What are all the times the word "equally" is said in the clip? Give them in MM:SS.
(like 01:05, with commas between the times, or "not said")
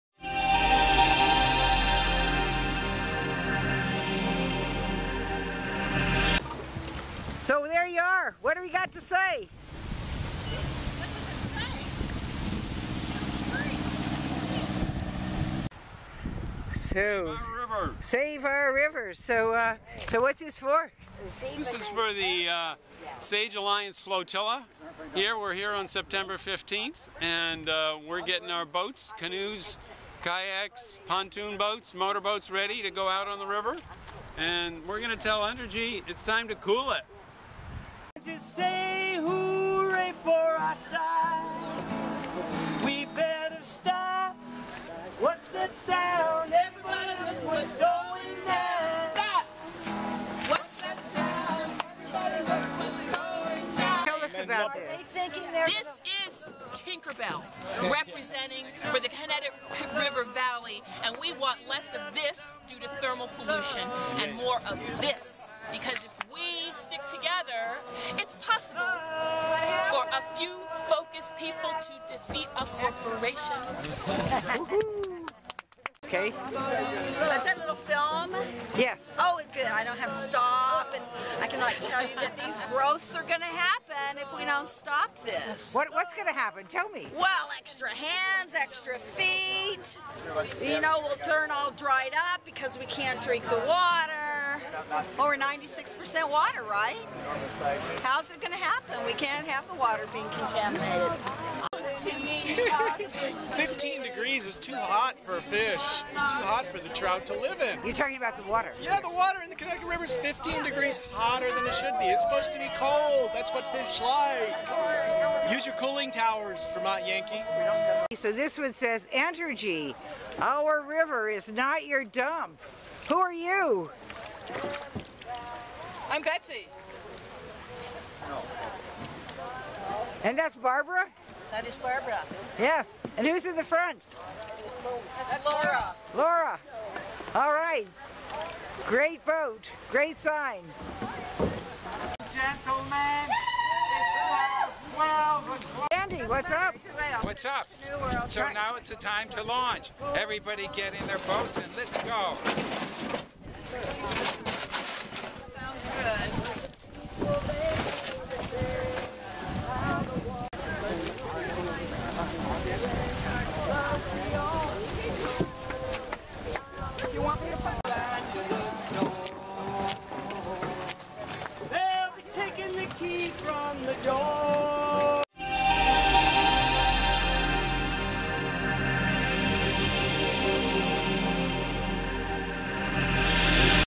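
not said.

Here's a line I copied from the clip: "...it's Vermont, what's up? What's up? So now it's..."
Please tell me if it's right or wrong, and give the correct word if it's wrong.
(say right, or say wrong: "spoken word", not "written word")
wrong: "Andy", not "Vermont".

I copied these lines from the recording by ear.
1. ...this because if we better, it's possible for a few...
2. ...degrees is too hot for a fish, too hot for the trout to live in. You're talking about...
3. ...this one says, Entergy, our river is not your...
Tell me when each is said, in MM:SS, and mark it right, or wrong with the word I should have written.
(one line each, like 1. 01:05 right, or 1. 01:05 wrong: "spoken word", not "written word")
1. 01:05 wrong: "together", not "better"
2. 01:44 right
3. 01:58 right.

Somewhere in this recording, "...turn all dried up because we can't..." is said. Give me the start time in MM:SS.
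01:31.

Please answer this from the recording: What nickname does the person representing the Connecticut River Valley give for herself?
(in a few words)
Tinkerbell.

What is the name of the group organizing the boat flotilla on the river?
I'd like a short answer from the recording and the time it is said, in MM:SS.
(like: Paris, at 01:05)
Sage Alliance, at 00:23.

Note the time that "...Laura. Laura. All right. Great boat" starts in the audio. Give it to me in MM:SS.
02:15.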